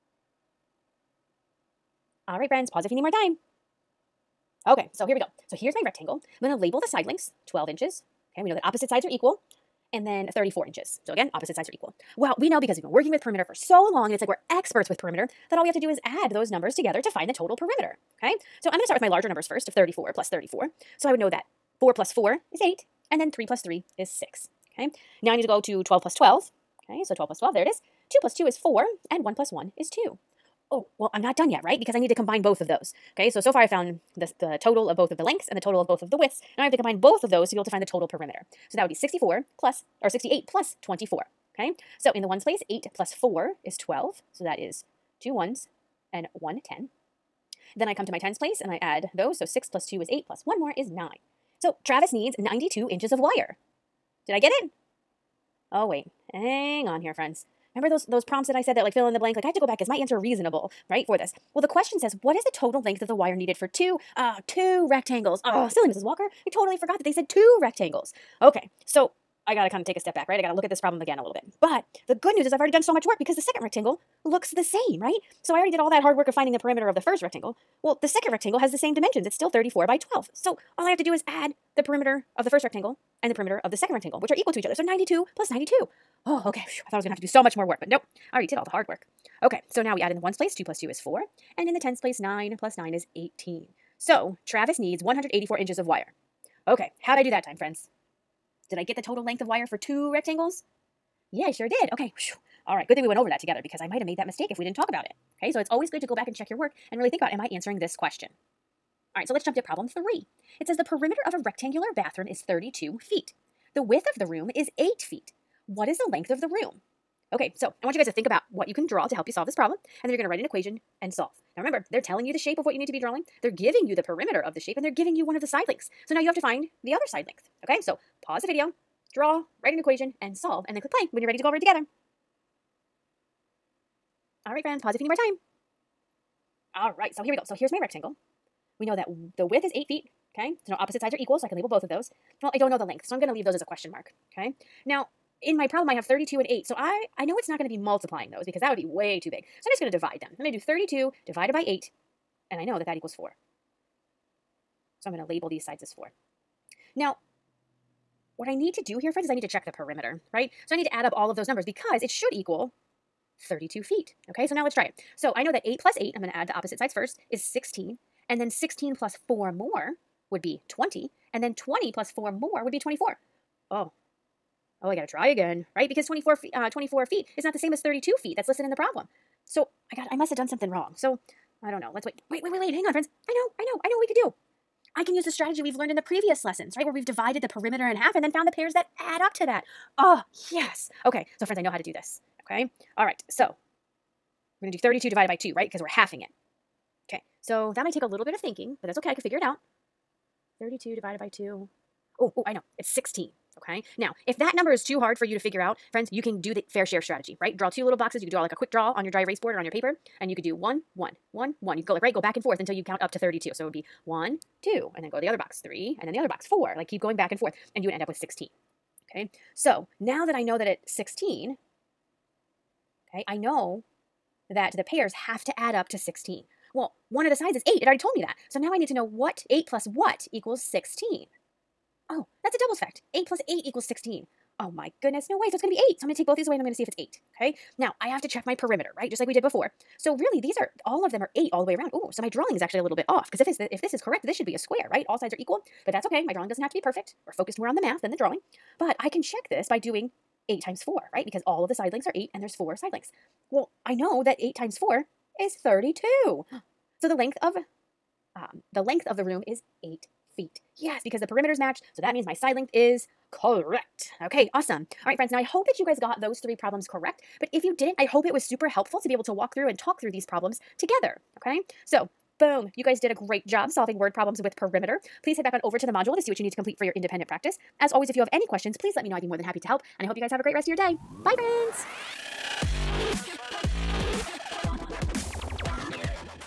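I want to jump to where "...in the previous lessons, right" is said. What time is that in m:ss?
3:05.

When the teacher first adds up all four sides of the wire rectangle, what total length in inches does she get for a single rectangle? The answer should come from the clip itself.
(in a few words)
92 inches.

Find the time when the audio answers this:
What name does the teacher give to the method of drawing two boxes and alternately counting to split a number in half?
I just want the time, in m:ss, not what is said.
3:26.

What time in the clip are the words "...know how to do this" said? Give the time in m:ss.
3:11.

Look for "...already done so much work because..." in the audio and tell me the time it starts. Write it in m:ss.
1:12.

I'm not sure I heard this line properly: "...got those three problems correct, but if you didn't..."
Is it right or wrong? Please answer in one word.
right.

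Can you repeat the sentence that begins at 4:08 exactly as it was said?
But I can check this by doing 8 times 4, right?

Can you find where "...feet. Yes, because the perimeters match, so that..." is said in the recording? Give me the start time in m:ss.
4:20.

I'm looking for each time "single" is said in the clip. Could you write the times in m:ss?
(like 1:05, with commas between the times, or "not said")
not said.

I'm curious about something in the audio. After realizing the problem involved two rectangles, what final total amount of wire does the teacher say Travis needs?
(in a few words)
184 inches.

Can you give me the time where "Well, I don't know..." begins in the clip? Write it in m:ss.
2:22.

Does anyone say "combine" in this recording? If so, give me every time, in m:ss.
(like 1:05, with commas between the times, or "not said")
0:32, 0:36.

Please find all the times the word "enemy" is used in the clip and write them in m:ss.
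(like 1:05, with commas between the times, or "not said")
not said.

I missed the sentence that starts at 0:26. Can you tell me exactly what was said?
Okay, so 12 plus 12, there it is.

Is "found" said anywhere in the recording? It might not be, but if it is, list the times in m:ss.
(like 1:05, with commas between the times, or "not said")
0:33, 3:08.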